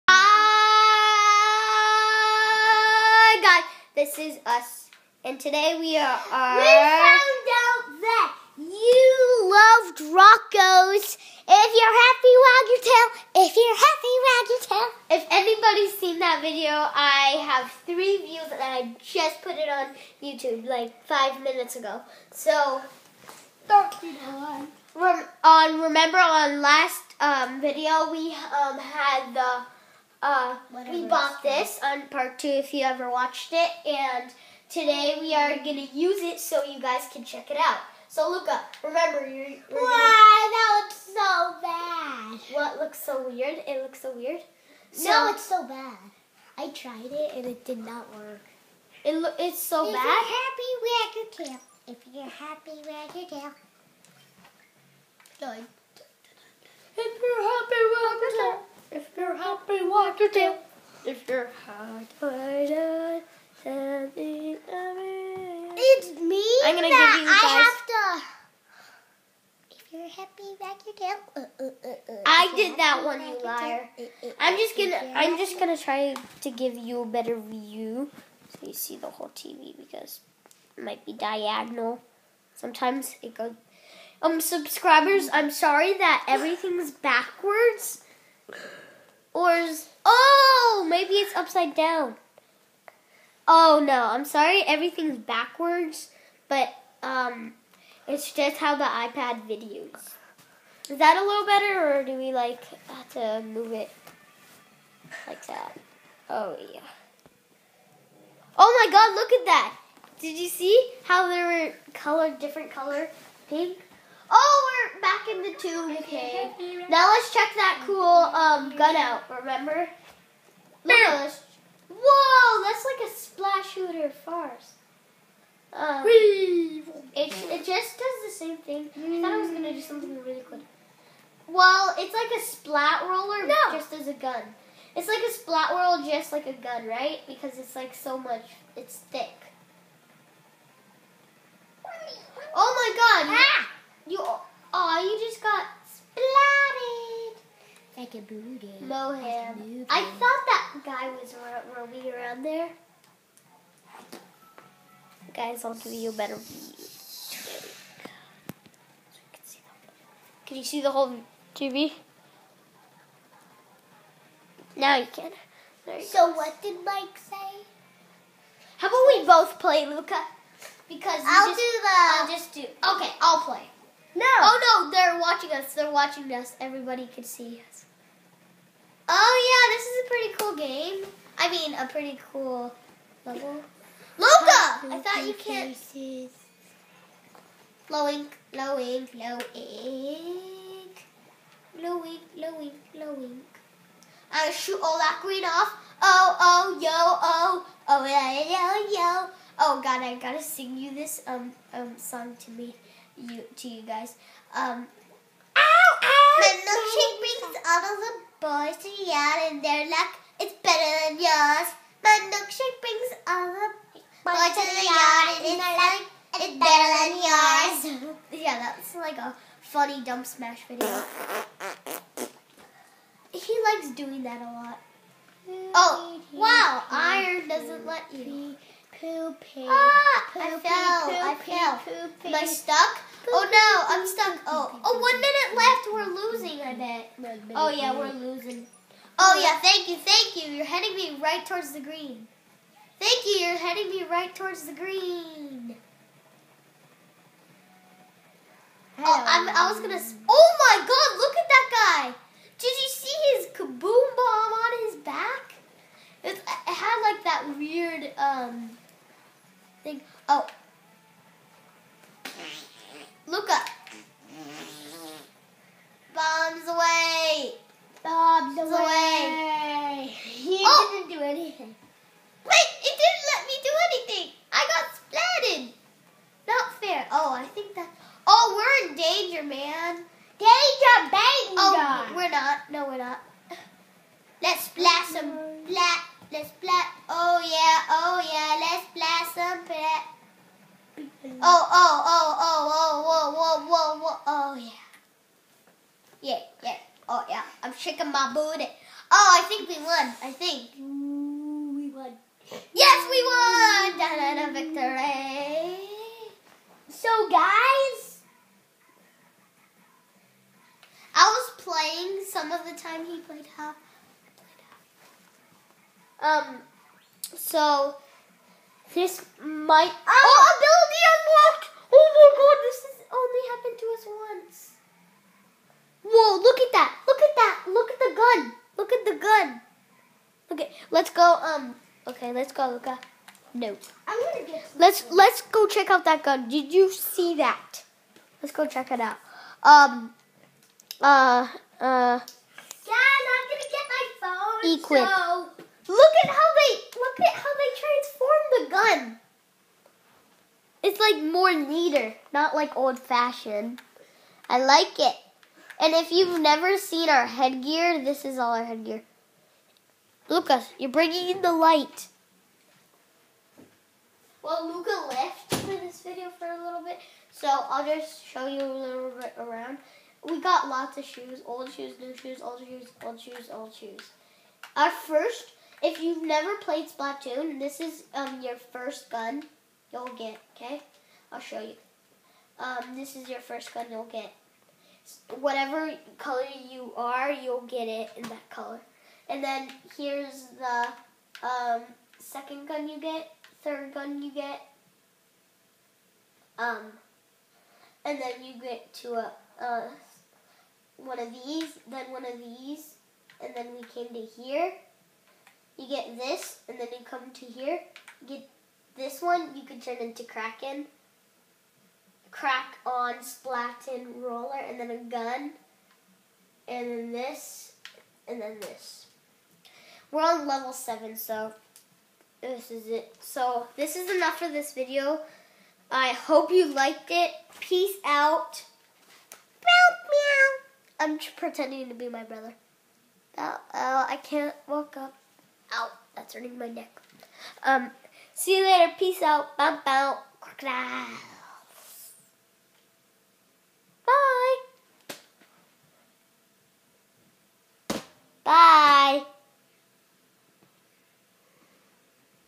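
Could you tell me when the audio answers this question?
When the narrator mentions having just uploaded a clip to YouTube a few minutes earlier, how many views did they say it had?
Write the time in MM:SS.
00:17.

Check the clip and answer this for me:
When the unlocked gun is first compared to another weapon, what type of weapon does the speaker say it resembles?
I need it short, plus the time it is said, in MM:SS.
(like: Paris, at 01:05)
splat roller, at 02:12.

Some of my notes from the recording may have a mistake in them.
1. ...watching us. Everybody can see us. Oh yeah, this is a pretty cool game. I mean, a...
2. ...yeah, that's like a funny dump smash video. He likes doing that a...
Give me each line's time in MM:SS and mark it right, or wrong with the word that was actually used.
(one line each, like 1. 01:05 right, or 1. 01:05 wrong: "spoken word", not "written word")
1. 02:55 right
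2. 03:38 right.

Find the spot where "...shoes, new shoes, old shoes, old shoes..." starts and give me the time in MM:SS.
06:11.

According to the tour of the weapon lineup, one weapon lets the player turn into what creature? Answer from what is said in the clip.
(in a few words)
Kraken.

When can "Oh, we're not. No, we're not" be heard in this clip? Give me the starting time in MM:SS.
04:41.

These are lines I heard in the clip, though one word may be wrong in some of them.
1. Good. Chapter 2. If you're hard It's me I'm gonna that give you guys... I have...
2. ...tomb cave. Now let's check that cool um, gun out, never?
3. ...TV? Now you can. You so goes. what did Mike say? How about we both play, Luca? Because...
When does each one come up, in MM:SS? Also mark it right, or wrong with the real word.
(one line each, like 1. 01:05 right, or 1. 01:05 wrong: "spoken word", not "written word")
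1. 00:55 right
2. 01:55 wrong: "remember", not "never"
3. 02:41 right.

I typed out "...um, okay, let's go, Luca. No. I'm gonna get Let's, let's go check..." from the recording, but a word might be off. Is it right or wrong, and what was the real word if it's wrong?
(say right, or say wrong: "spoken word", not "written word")
right.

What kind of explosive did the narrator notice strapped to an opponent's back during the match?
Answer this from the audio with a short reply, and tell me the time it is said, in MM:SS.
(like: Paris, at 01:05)
kaboom bomb, at 04:13.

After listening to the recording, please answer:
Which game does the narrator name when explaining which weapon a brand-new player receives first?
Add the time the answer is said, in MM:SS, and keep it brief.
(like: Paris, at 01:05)
Splatoon, at 06:16.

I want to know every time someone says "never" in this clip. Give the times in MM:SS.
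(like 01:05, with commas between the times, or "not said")
05:56, 06:16.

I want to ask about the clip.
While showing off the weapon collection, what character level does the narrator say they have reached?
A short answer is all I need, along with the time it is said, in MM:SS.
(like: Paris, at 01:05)
7, at 07:00.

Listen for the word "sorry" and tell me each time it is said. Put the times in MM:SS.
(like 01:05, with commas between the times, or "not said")
01:25, 01:34.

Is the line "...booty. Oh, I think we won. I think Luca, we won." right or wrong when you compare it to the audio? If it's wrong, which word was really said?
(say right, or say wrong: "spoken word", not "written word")
wrong: "Ooh", not "Luca".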